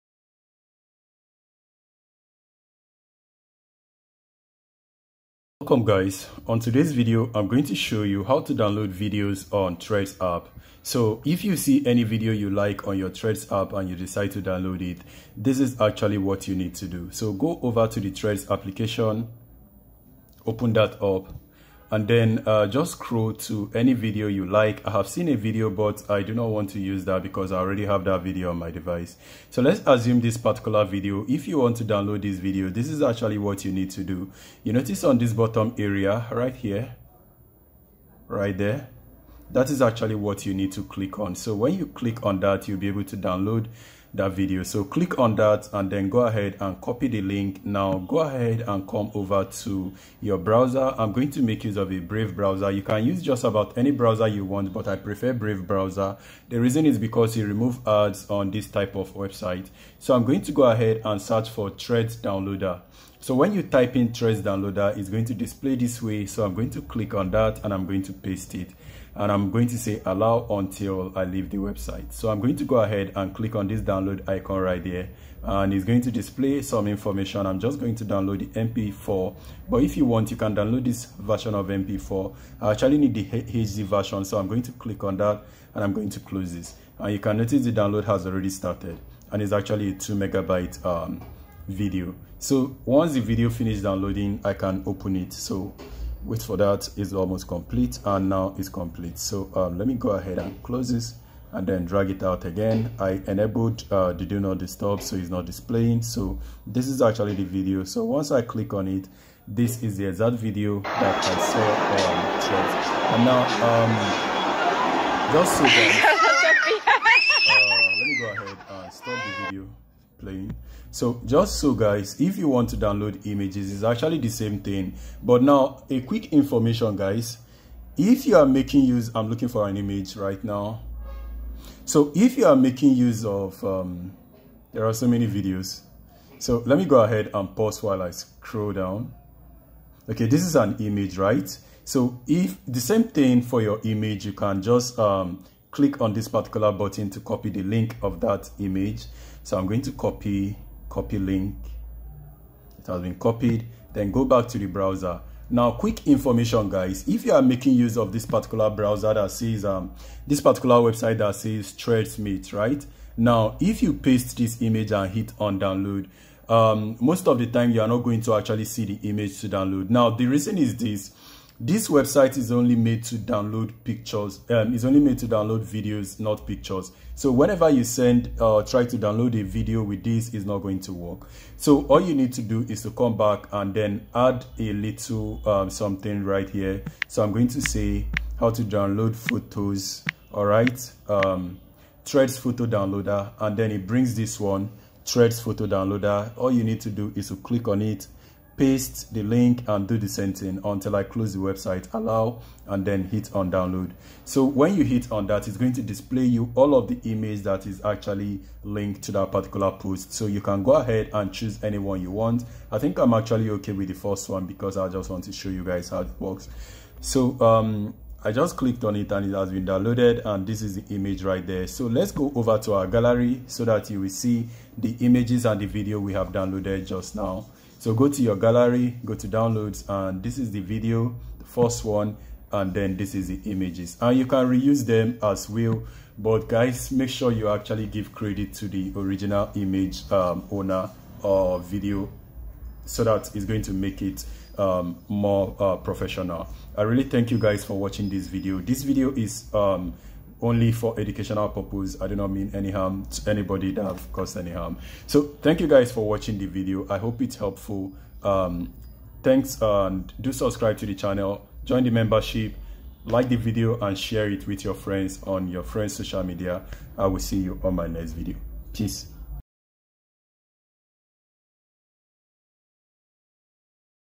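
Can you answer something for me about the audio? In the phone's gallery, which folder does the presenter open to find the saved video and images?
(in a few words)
Downloads.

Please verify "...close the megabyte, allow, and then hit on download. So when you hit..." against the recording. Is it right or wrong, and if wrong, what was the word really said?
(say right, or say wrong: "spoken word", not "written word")
wrong: "website", not "megabyte".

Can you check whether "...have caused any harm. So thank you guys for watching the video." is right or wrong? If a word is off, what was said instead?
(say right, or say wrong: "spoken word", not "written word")
right.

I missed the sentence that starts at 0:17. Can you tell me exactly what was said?
So go over to the Threads application, open that up and then uh, just scroll to any video you like.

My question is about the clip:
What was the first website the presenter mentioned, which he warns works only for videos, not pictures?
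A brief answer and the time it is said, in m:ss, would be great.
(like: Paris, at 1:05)
Threadsmith, at 2:41.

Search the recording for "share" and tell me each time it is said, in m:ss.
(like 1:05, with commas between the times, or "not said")
4:23.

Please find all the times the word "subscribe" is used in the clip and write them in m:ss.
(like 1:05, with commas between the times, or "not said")
4:20.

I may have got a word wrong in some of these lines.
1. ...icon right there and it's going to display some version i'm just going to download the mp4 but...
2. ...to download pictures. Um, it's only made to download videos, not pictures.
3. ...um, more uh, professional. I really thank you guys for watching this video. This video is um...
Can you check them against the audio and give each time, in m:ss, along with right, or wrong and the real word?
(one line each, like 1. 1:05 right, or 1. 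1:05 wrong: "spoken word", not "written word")
1. 1:14 wrong: "information", not "version"
2. 2:53 right
3. 4:04 right.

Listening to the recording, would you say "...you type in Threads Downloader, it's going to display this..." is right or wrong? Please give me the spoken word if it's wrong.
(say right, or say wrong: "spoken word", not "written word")
right.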